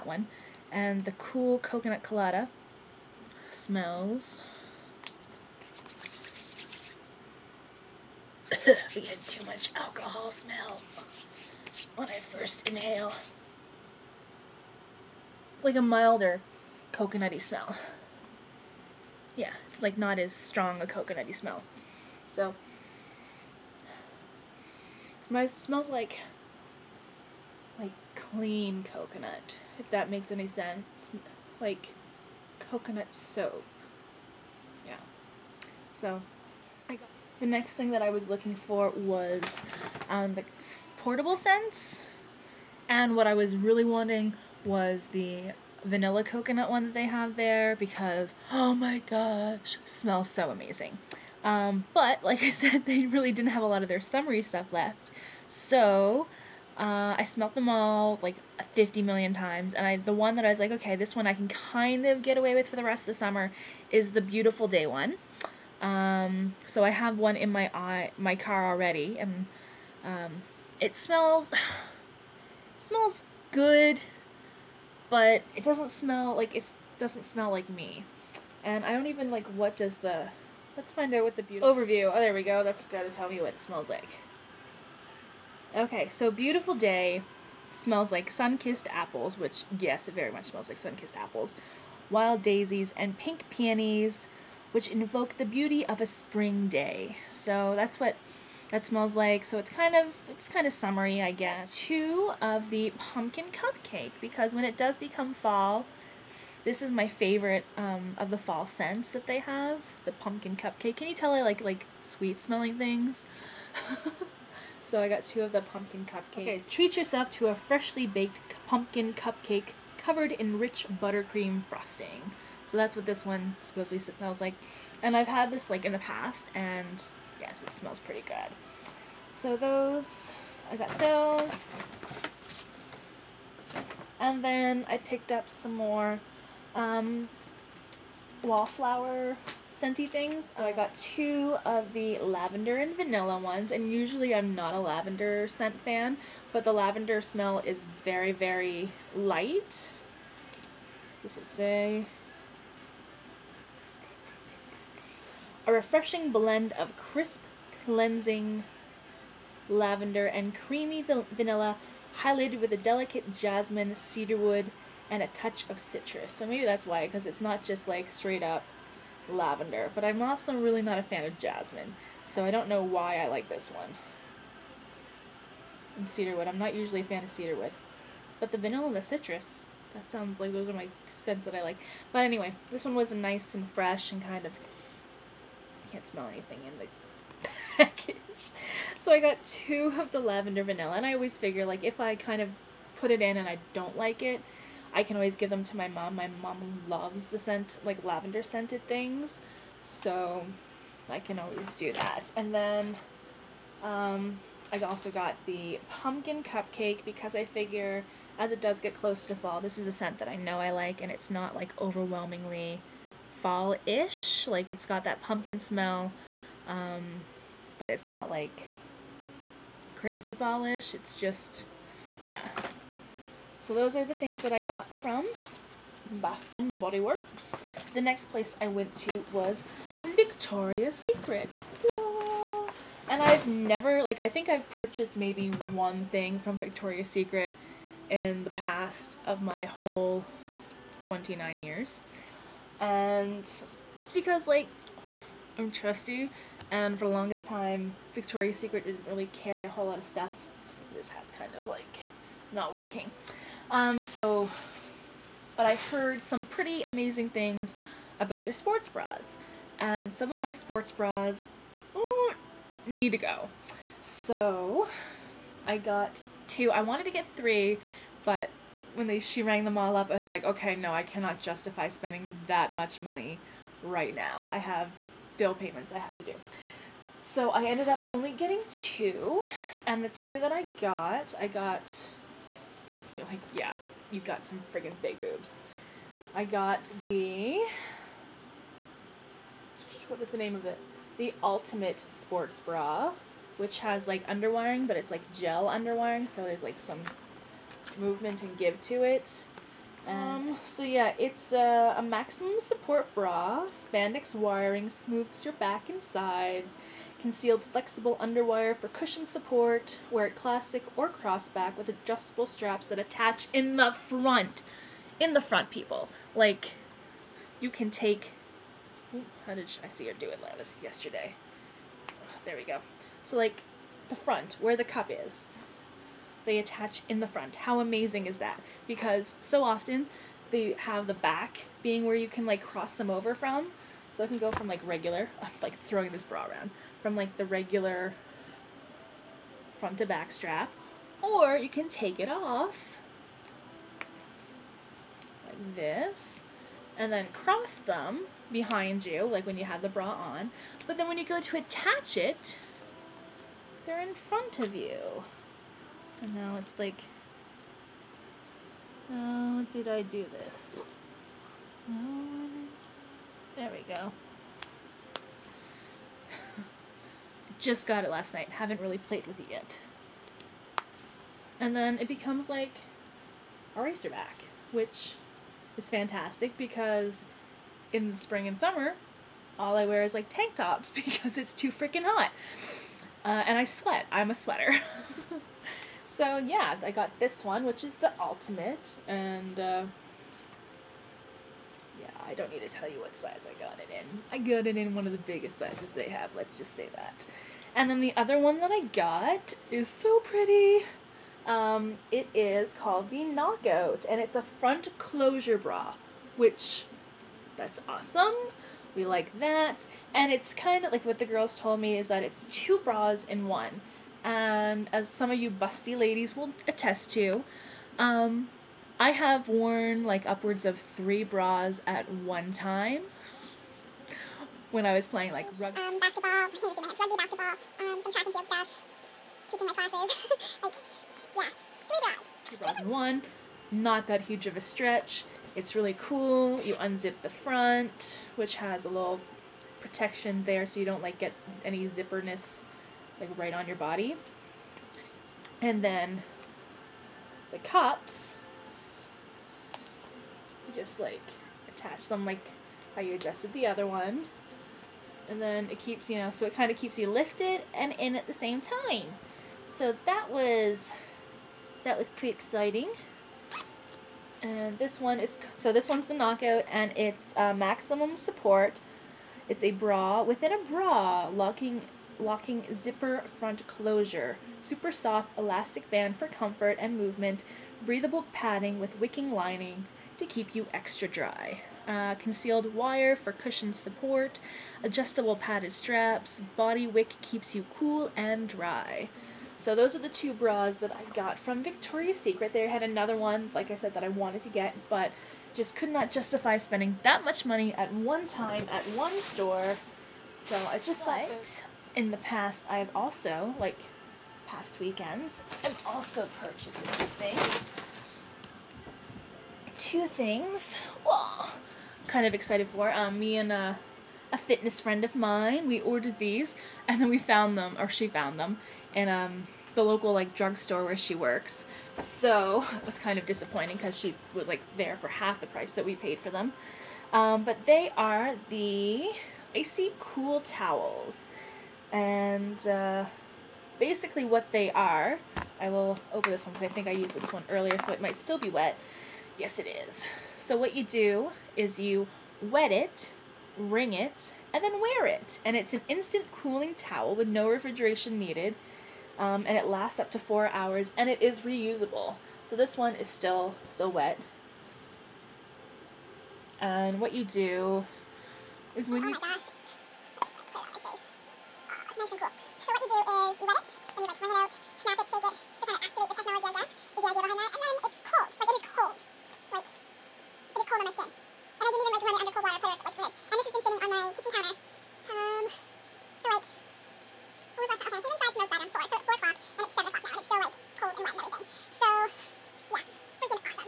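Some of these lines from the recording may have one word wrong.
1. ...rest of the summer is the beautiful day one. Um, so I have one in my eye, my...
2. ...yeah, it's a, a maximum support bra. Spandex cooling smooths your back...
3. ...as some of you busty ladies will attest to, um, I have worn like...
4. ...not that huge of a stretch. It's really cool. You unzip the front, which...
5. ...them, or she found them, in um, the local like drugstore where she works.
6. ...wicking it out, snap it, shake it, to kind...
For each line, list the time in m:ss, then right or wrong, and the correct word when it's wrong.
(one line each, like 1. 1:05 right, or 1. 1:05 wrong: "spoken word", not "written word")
1. 1:02 right
2. 5:00 wrong: "wiring", not "cooling"
3. 6:54 right
4. 7:13 right
5. 8:37 right
6. 9:24 wrong: "wring", not "wicking".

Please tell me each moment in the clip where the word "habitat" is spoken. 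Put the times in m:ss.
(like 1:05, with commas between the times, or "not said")
not said.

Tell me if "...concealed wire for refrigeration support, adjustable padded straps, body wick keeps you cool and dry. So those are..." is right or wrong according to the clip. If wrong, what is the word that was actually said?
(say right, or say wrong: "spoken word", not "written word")
wrong: "cushion", not "refrigeration".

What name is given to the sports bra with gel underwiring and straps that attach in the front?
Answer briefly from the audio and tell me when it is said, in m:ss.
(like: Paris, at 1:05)
The Ultimate Sports Bra, at 4:51.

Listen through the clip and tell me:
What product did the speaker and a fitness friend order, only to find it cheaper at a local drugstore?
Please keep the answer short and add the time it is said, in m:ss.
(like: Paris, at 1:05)
Icy cool towels, at 8:49.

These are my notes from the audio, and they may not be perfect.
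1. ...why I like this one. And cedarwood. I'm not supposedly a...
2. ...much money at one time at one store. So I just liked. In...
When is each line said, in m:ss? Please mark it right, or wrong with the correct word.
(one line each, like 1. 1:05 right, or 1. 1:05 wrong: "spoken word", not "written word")
1. 2:52 wrong: "usually", not "supposedly"
2. 8:17 right.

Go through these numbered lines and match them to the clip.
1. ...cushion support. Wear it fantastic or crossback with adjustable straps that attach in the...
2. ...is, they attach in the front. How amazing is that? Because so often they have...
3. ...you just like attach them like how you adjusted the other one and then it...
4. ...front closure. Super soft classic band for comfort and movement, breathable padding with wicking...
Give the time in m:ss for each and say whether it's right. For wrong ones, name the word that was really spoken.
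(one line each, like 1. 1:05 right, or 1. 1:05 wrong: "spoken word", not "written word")
1. 5:08 wrong: "classic", not "fantastic"
2. 5:25 right
3. 7:30 right
4. 7:53 wrong: "elastic", not "classic".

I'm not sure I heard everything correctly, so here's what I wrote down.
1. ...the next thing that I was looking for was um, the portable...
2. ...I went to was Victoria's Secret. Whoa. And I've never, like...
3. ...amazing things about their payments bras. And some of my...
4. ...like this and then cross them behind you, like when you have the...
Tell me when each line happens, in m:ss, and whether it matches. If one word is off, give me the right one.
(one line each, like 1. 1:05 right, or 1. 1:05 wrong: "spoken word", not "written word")
1. 0:37 right
2. 3:48 right
3. 4:16 wrong: "sports", not "payments"
4. 5:45 right.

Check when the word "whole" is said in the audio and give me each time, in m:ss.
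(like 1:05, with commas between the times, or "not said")
3:59, 4:09.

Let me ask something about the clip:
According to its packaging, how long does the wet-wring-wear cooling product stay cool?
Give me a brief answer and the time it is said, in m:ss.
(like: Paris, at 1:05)
Up to 4 hours, at 9:10.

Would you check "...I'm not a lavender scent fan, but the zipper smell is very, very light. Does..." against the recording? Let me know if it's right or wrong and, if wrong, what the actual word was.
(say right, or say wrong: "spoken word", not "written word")
wrong: "lavender", not "zipper".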